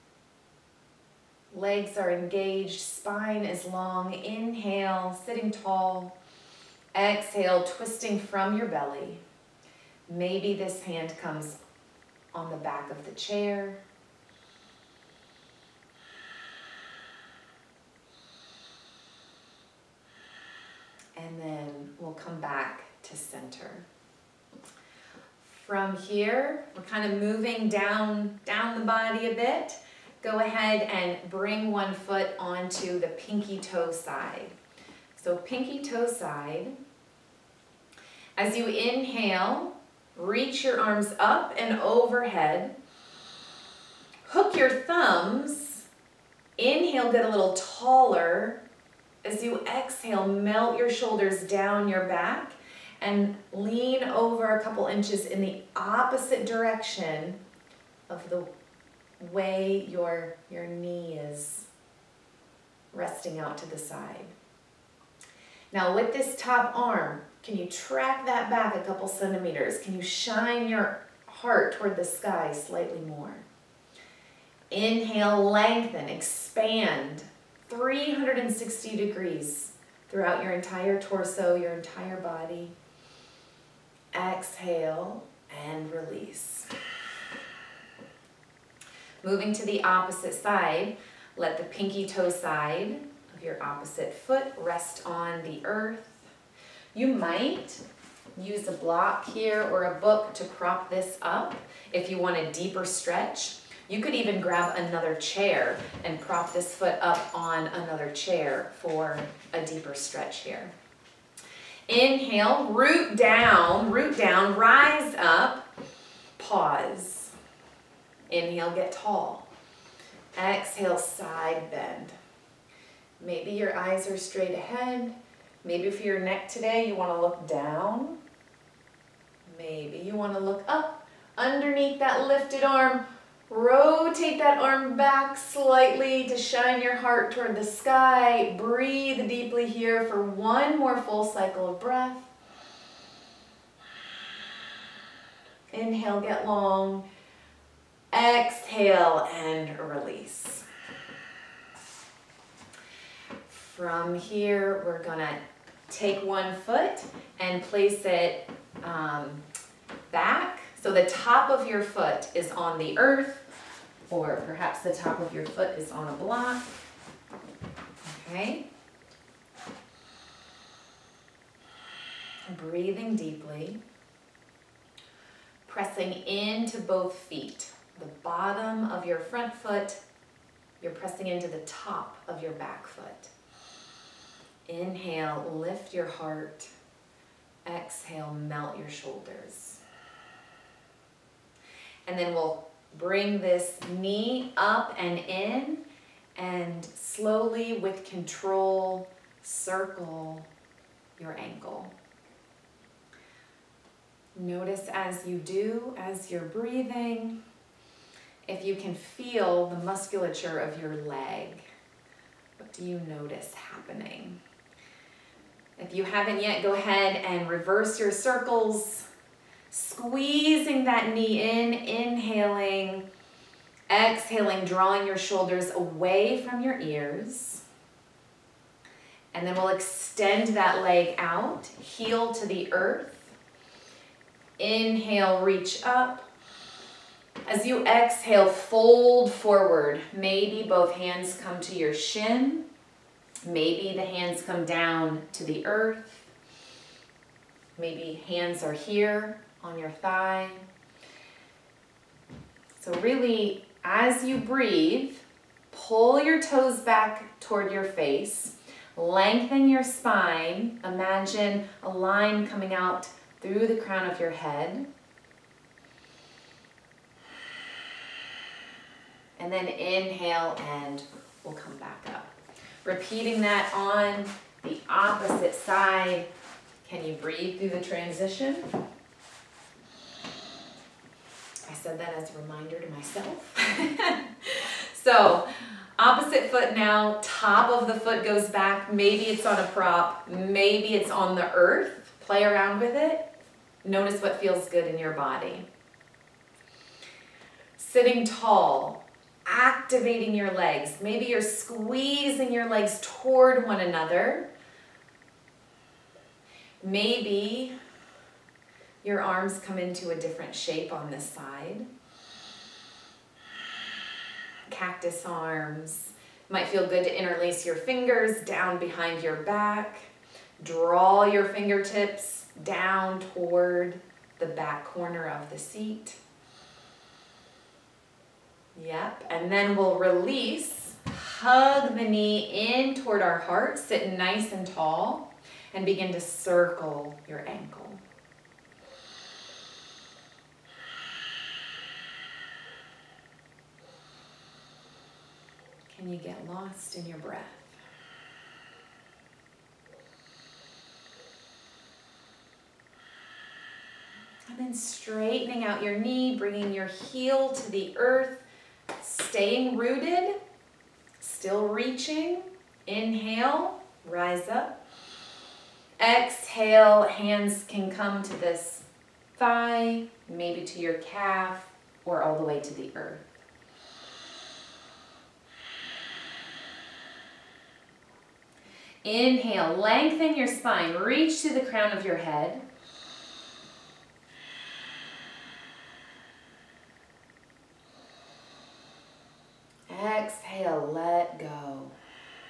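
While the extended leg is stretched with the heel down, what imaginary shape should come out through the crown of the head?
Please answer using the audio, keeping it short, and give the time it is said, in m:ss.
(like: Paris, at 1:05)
a line, at 4:21.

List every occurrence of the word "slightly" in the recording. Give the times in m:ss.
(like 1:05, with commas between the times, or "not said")
1:12, 2:15.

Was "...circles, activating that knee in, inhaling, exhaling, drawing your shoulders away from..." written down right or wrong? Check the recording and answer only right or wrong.
wrong.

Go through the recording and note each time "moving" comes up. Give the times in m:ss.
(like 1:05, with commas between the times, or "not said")
0:27, 1:29.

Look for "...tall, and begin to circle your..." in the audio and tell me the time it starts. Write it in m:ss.
5:34.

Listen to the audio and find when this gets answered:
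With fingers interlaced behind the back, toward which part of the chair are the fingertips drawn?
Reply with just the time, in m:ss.
5:24.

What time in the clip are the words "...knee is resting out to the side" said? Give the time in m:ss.
1:00.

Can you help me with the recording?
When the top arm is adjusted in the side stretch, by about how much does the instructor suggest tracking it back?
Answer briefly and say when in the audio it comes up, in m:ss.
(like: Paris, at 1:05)
a couple centimeters, at 1:08.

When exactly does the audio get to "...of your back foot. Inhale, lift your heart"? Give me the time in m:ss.
3:02.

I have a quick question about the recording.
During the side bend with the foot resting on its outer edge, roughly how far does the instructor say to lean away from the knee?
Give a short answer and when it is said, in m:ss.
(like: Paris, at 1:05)
a couple inches, at 0:54.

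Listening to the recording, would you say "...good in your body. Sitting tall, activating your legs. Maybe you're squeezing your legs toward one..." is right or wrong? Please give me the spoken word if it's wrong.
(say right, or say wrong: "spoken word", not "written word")
right.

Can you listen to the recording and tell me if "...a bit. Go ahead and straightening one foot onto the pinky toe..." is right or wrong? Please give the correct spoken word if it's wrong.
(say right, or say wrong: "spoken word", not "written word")
wrong: "bring", not "straightening".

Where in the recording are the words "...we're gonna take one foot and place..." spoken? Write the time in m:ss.
2:34.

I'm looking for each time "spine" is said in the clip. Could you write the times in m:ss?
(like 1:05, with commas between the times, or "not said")
0:02, 4:19, 6:20.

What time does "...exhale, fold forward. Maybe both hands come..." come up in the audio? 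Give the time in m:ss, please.
3:57.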